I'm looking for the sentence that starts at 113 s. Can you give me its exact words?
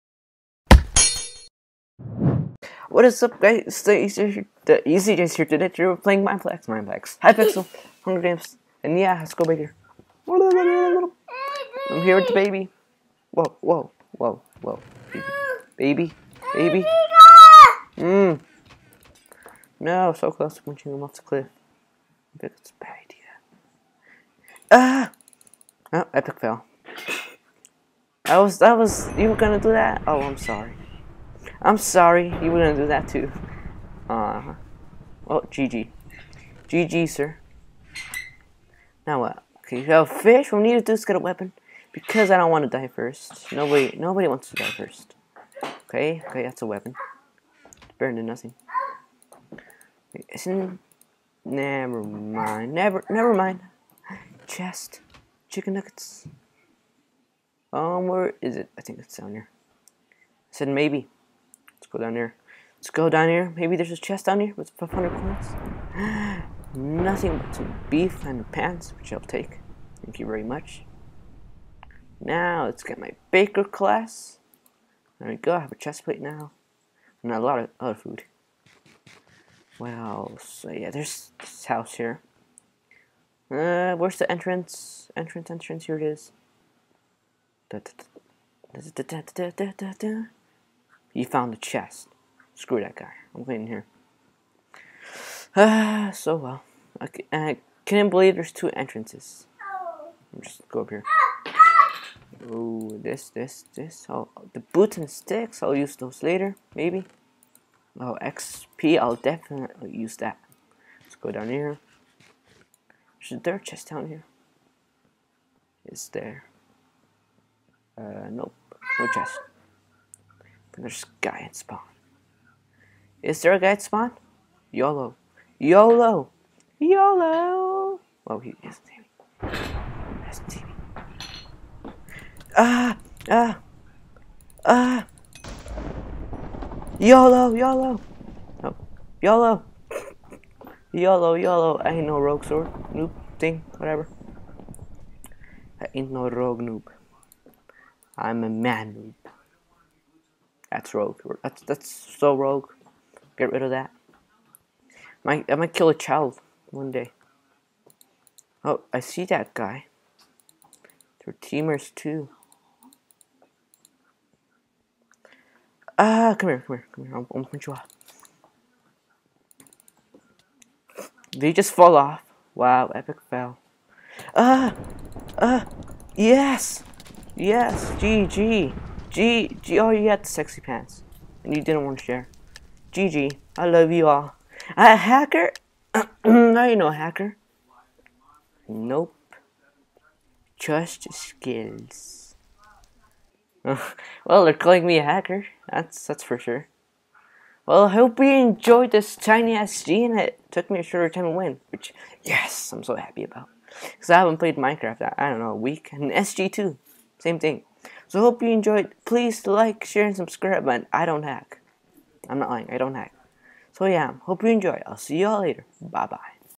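There's a dirt chest down here.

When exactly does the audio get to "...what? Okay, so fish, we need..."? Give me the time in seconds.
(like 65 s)
39 s.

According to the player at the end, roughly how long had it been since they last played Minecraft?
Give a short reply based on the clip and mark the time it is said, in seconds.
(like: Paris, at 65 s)
a week, at 205 s.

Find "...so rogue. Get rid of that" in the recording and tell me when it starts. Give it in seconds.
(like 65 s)
151 s.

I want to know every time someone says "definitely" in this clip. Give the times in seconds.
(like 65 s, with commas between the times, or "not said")
109 s.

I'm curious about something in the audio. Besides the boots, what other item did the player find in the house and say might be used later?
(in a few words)
sticks.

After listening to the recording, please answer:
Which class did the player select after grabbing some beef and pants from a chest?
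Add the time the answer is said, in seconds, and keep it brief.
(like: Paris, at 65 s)
baker, at 73 s.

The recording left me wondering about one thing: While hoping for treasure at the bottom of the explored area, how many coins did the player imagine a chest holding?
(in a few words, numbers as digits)
500.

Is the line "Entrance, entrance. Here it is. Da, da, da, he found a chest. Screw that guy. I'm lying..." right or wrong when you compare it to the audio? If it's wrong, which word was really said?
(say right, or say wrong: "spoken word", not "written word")
wrong: "waiting", not "lying".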